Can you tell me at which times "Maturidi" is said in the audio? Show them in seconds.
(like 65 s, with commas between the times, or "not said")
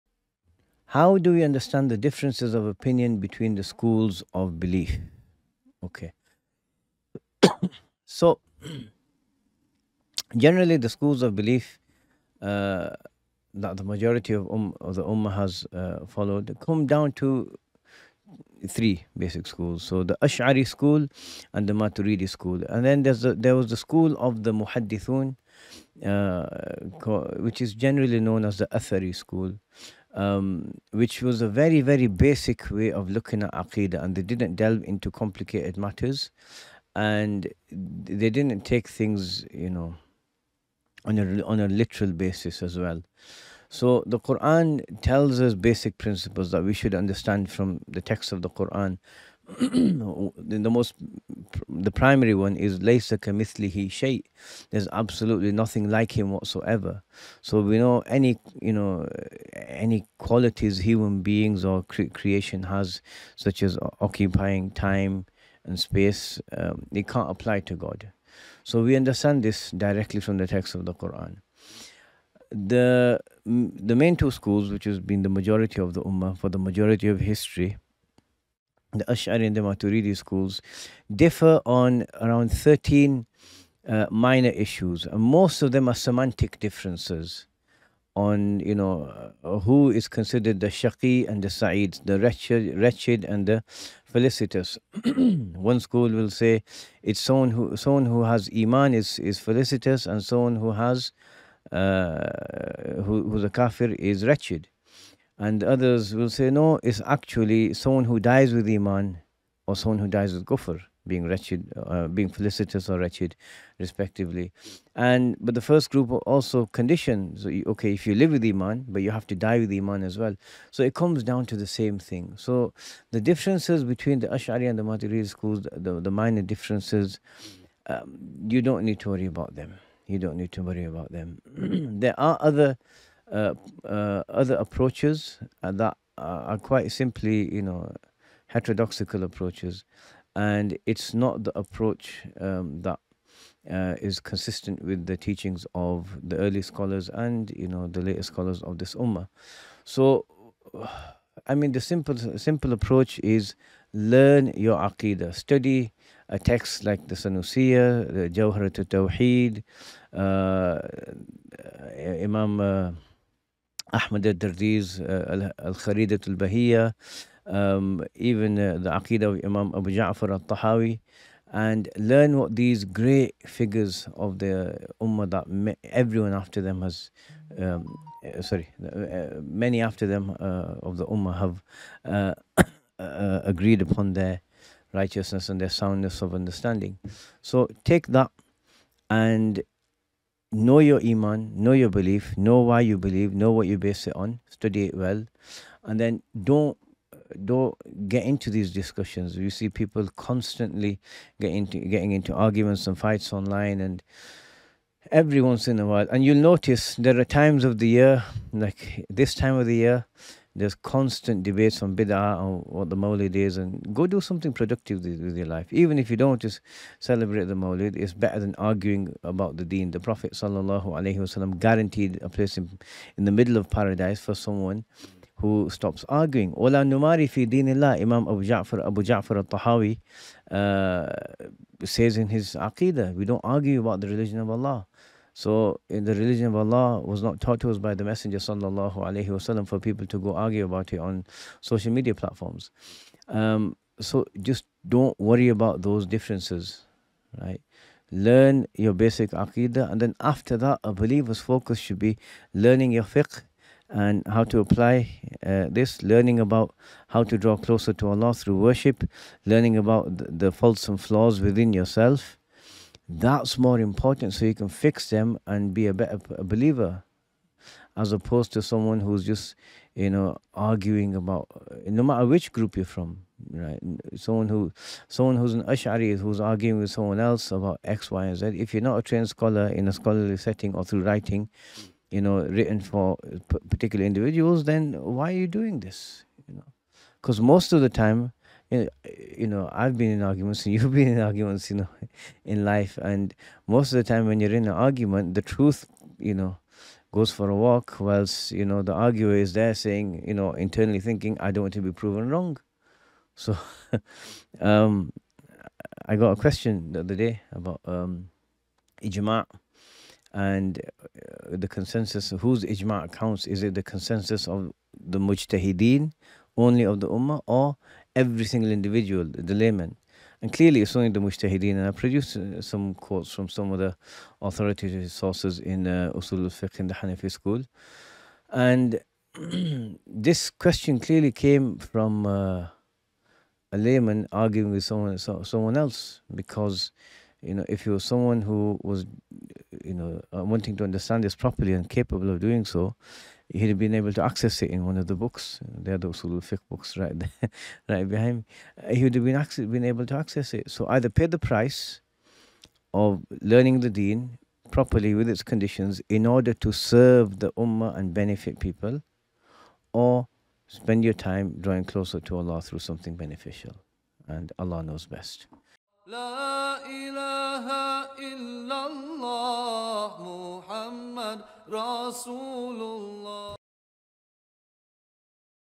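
21 s, 79 s, 124 s.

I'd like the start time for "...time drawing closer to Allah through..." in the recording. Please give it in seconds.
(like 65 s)
361 s.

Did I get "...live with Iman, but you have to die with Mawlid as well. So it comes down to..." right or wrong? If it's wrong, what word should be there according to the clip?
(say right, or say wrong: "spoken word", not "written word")
wrong: "Iman", not "Mawlid".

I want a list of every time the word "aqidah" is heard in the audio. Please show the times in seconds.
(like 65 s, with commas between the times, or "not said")
33 s, 154 s, 168 s, 232 s, 249 s.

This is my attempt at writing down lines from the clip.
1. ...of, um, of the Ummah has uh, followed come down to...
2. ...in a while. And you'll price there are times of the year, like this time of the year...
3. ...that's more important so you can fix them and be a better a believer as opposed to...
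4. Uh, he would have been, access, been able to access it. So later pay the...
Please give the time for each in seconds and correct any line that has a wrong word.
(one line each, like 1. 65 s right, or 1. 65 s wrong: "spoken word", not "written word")
1. 14 s right
2. 205 s wrong: "notice", not "price"
3. 263 s right
4. 348 s wrong: "either", not "later".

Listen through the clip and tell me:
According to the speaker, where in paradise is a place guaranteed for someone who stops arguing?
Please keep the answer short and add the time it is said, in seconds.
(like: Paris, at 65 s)
In the middle, at 223 s.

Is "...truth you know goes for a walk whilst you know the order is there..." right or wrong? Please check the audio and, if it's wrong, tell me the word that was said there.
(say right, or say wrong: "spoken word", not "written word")
wrong: "arguer", not "order".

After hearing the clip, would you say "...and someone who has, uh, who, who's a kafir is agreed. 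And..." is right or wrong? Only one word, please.
wrong.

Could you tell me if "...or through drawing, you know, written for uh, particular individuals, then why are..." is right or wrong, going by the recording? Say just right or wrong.
wrong.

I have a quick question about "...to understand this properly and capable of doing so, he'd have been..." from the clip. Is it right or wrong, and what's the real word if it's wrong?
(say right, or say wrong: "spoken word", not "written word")
right.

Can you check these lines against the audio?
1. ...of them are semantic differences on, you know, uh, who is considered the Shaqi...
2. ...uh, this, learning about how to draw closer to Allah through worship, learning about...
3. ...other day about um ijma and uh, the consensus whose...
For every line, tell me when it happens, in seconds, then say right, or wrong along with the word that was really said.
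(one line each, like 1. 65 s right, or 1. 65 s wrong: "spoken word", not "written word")
1. 85 s right
2. 255 s right
3. 307 s right.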